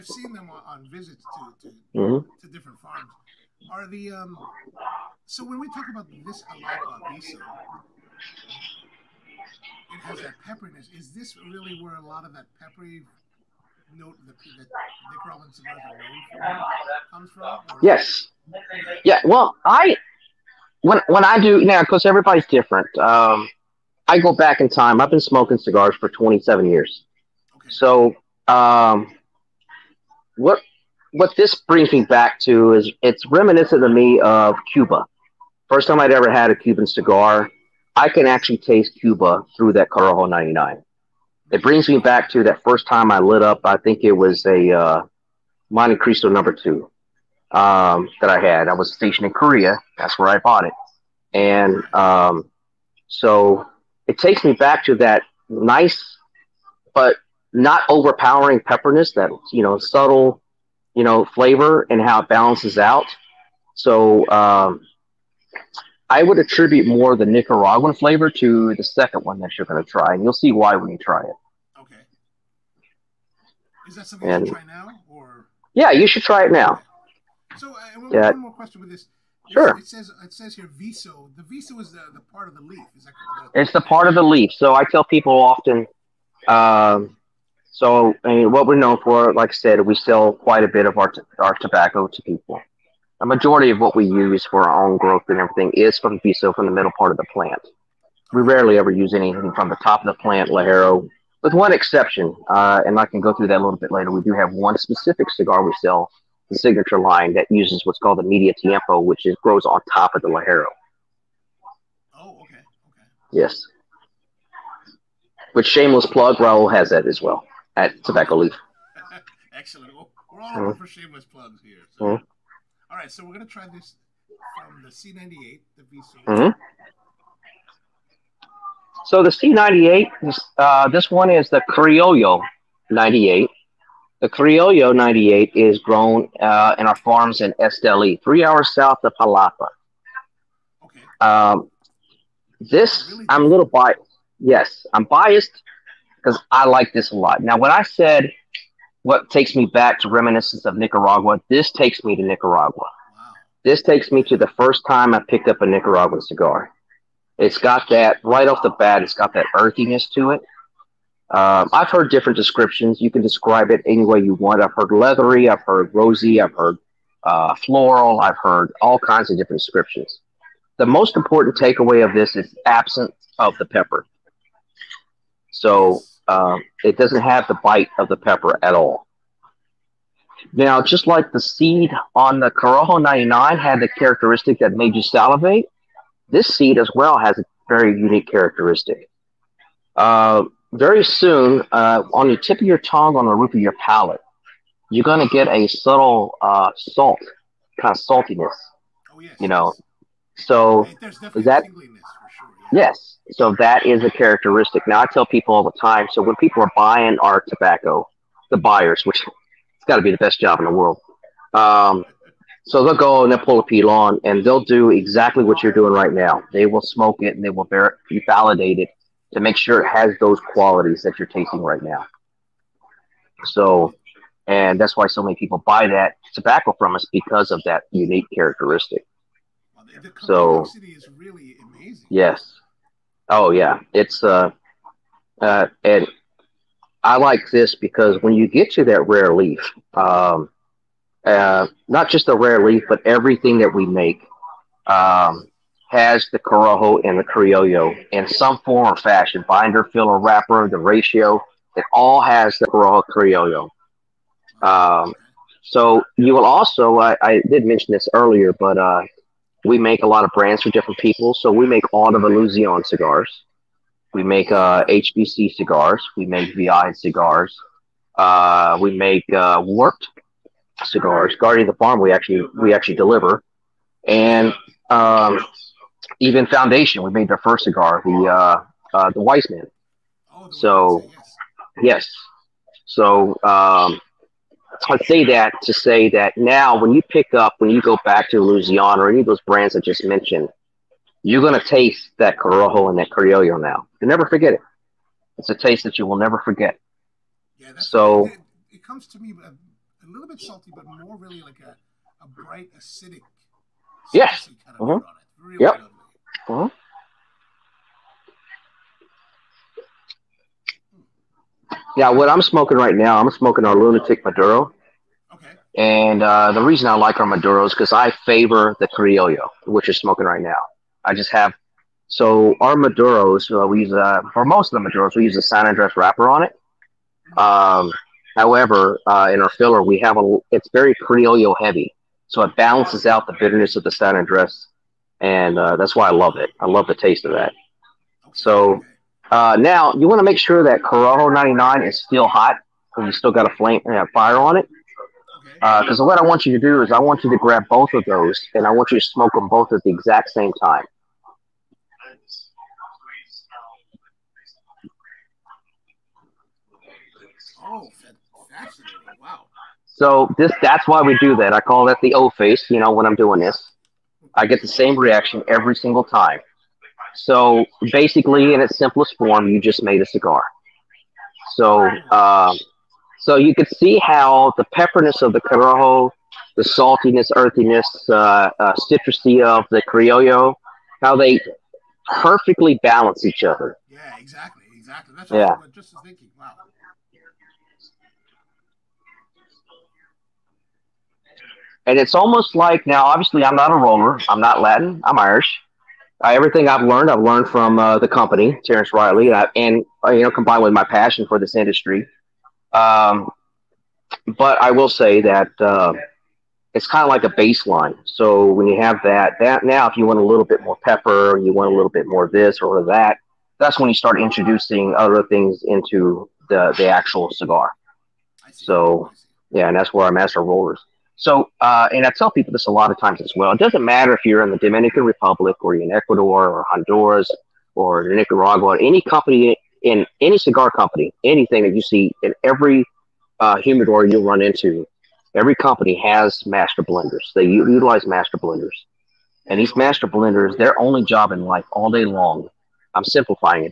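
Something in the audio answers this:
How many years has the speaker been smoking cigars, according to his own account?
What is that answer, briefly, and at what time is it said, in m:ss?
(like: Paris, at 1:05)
27, at 0:26.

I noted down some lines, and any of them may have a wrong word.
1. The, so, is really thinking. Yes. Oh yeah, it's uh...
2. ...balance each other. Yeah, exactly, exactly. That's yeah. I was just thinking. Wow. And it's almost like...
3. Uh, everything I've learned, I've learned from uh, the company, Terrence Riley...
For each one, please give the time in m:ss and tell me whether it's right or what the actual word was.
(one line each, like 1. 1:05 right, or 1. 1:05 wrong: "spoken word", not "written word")
1. 3:50 wrong: "amazing", not "thinking"
2. 6:22 right
3. 6:36 right.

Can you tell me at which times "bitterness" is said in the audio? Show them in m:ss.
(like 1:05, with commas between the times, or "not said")
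5:33.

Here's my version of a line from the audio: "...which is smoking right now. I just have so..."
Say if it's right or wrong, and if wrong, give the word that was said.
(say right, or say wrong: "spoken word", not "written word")
right.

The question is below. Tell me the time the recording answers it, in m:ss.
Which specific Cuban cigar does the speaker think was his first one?
0:45.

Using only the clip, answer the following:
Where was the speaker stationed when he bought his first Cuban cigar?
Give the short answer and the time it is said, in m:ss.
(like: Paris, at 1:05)
Korea, at 0:49.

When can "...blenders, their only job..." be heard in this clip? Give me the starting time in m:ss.
7:20.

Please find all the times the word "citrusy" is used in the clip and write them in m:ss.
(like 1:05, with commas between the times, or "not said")
6:18.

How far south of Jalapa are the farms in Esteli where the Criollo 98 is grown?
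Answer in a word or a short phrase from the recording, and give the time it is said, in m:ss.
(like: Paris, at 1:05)
3 hours, at 2:18.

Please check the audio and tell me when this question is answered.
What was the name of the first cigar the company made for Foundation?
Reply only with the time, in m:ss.
4:39.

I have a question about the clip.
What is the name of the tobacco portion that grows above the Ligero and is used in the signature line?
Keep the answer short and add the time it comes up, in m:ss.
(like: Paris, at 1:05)
Media Tiempo, at 1:48.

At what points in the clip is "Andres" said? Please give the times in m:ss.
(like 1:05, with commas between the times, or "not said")
5:25, 5:34.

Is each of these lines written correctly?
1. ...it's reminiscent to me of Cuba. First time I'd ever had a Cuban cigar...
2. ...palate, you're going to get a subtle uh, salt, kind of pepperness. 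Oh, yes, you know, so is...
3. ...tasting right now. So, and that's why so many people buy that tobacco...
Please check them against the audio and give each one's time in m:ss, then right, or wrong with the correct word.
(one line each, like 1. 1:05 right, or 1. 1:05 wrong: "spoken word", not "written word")
1. 0:33 right
2. 3:13 wrong: "saltiness", not "pepperness"
3. 3:41 right.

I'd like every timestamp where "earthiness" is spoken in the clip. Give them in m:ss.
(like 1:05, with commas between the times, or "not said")
2:39, 6:17.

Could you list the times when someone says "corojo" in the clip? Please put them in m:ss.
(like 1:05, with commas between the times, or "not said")
0:39, 3:02, 4:06, 4:12, 4:52, 5:40, 6:15.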